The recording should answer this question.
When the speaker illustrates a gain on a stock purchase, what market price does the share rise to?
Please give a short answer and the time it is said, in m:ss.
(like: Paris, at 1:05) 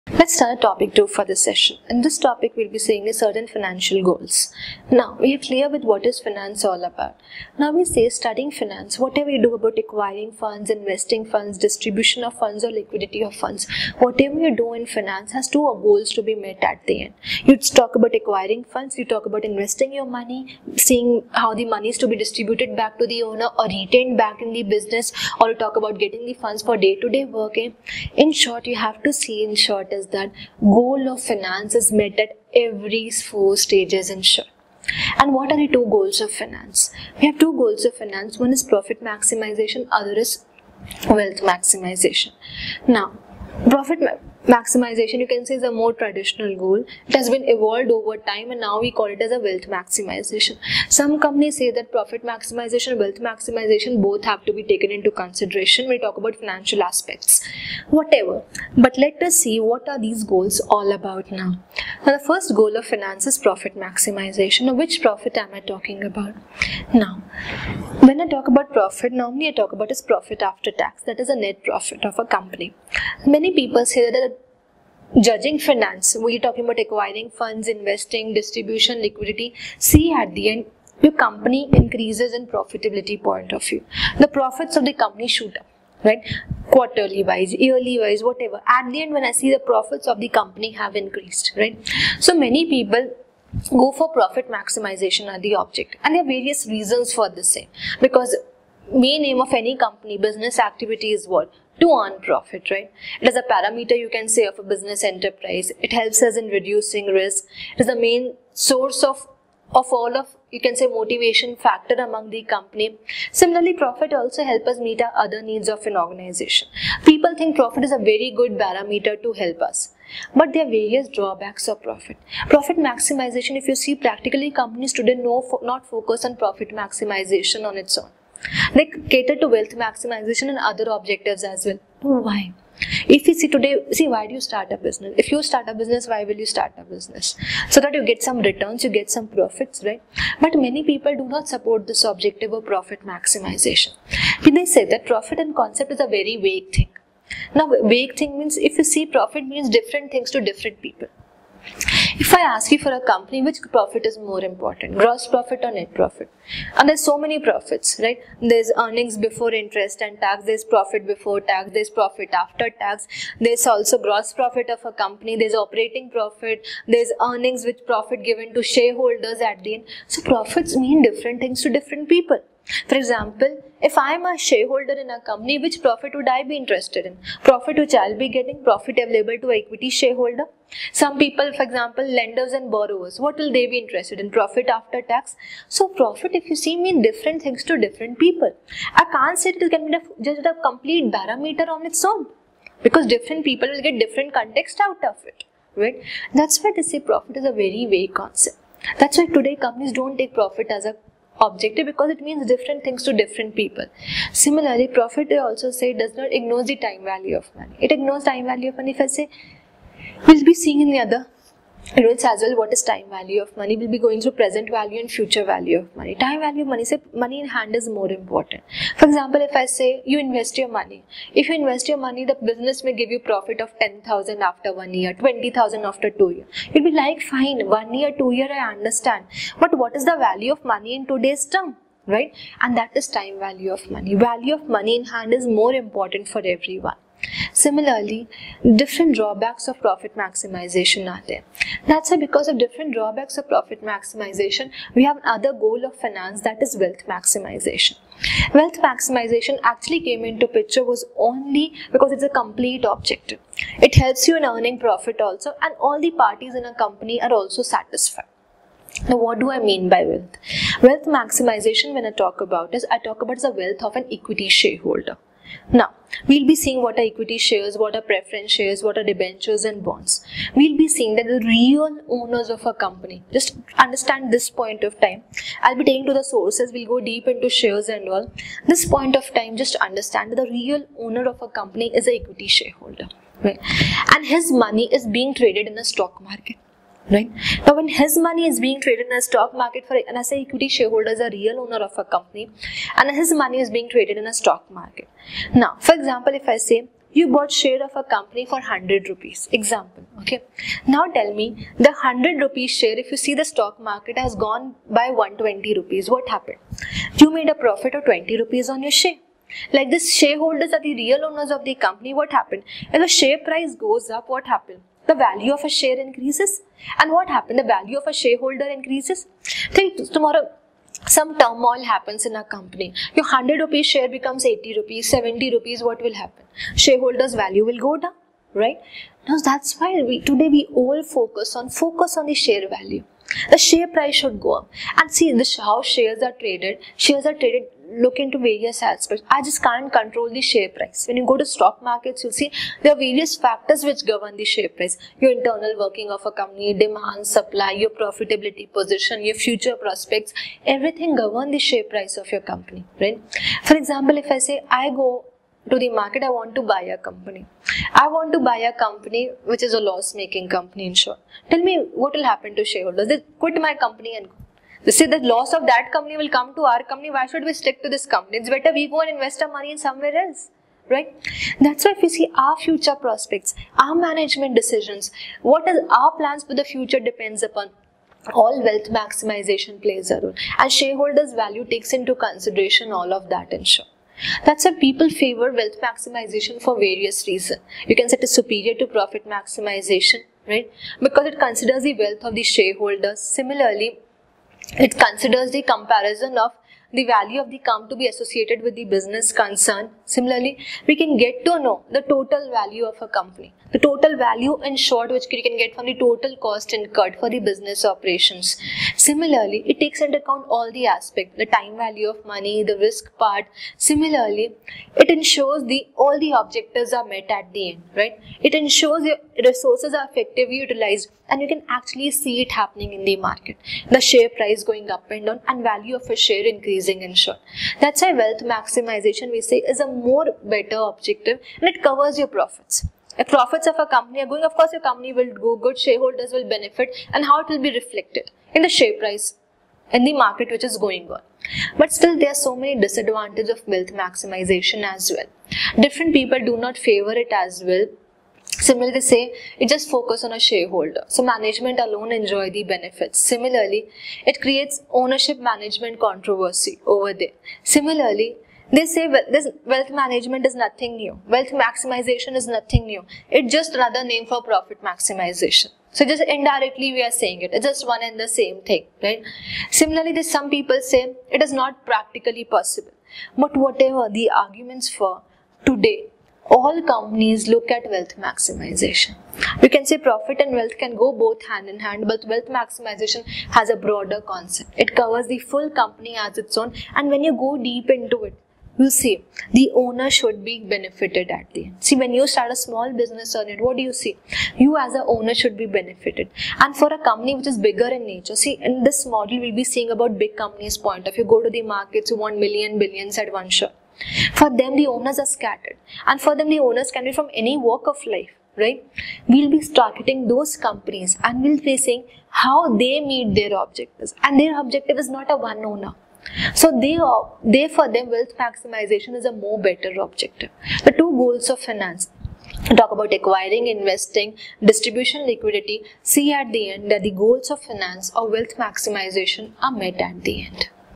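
120 rupees, at 5:05.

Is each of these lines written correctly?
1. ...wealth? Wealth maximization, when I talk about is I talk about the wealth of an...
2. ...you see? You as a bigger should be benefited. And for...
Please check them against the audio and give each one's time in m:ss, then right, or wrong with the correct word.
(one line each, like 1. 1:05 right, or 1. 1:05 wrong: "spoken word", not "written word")
1. 4:20 right
2. 8:13 wrong: "owner", not "bigger".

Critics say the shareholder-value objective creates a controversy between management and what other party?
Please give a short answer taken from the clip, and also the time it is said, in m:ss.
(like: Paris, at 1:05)
ownership, at 7:34.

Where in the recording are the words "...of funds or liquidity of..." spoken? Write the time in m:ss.
0:12.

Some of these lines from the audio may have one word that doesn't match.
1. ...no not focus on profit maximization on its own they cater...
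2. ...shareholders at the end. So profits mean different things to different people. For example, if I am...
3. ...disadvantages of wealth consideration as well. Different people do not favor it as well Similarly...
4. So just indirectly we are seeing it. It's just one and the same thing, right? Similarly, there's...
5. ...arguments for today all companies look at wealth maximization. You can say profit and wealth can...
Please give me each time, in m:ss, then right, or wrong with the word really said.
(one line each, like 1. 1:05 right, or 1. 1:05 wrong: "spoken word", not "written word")
1. 2:05 right
2. 2:48 right
3. 7:22 wrong: "maximization", not "consideration"
4. 7:45 wrong: "saying", not "seeing"
5. 7:54 right.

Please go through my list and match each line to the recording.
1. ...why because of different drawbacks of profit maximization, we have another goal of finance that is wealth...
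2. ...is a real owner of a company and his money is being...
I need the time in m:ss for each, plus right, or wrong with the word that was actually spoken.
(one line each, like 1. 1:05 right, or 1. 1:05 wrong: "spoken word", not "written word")
1. 4:02 right
2. 4:51 right.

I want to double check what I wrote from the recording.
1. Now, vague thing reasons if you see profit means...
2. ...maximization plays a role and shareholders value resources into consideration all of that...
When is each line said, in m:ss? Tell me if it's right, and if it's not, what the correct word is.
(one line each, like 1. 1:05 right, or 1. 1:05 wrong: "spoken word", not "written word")
1. 2:27 wrong: "means", not "reasons"
2. 6:18 wrong: "takes", not "resources".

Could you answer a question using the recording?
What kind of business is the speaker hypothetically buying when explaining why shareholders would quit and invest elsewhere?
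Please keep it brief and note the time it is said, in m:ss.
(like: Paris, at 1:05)
loss making company, at 5:59.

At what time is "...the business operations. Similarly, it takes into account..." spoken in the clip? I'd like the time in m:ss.
6:47.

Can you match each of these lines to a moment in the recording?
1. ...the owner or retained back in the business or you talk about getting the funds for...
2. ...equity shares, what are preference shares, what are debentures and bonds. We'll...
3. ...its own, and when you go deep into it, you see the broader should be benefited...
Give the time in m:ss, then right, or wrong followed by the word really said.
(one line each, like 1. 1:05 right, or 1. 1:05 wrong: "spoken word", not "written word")
1. 0:23 right
2. 4:27 right
3. 8:06 wrong: "owner", not "broader".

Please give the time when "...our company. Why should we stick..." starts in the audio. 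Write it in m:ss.
6:06.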